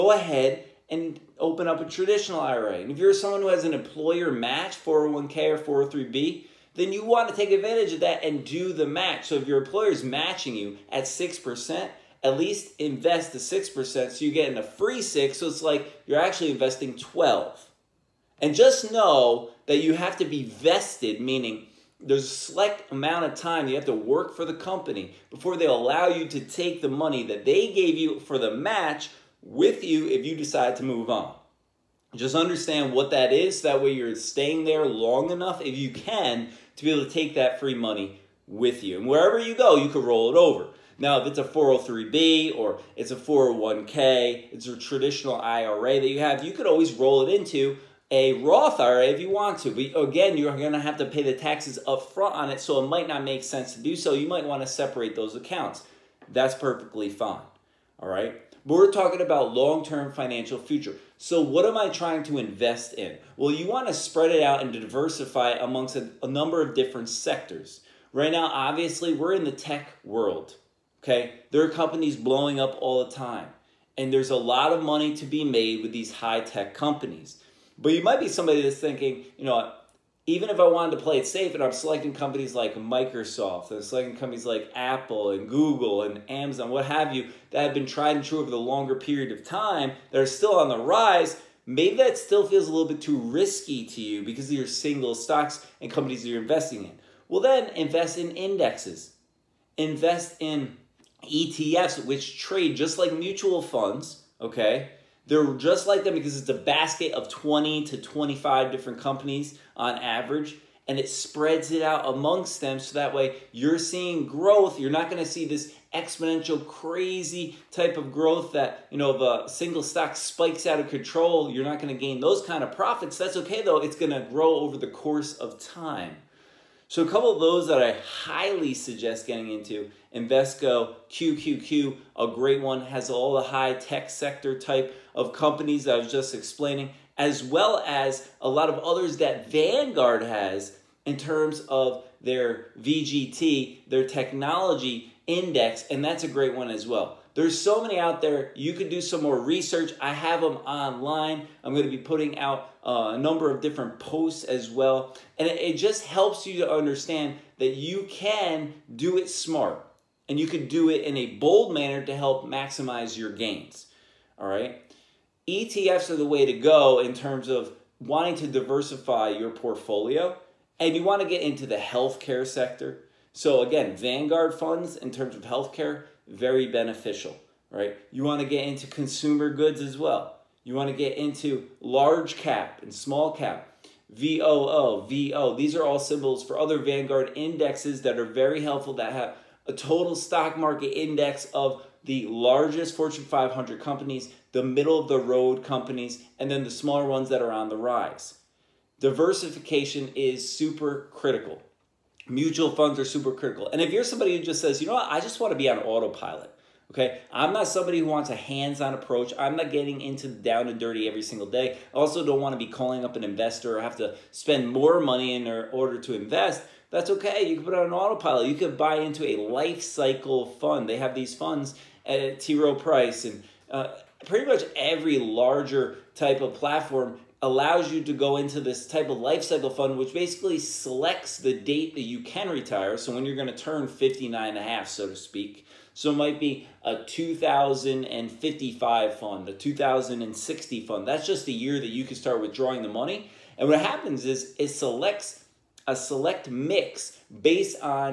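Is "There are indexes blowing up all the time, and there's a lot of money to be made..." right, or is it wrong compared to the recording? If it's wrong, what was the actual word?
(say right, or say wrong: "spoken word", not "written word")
wrong: "companies", not "indexes".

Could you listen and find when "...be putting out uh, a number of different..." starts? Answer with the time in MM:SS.
02:31.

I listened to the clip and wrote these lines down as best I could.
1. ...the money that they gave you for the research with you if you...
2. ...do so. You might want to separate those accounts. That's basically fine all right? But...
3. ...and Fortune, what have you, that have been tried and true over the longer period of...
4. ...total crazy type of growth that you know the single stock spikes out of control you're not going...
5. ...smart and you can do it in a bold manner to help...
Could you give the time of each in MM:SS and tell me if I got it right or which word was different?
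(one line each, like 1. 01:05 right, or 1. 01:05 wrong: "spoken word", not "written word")
1. 00:26 wrong: "match", not "research"
2. 00:53 wrong: "perfectly", not "basically"
3. 01:26 wrong: "Amazon", not "Fortune"
4. 01:55 wrong: "exponential", not "total"
5. 02:39 right.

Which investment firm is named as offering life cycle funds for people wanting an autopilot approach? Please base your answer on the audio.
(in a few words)
T. Rowe Price.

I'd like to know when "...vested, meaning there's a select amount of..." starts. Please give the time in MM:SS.
00:20.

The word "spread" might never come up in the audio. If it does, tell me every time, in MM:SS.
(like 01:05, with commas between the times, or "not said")
01:03, 01:51.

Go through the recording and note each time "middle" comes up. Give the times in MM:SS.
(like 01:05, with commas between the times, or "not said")
03:14.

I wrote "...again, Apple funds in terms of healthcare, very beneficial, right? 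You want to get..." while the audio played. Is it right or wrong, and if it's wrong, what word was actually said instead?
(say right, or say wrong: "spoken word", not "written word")
wrong: "Vanguard", not "Apple".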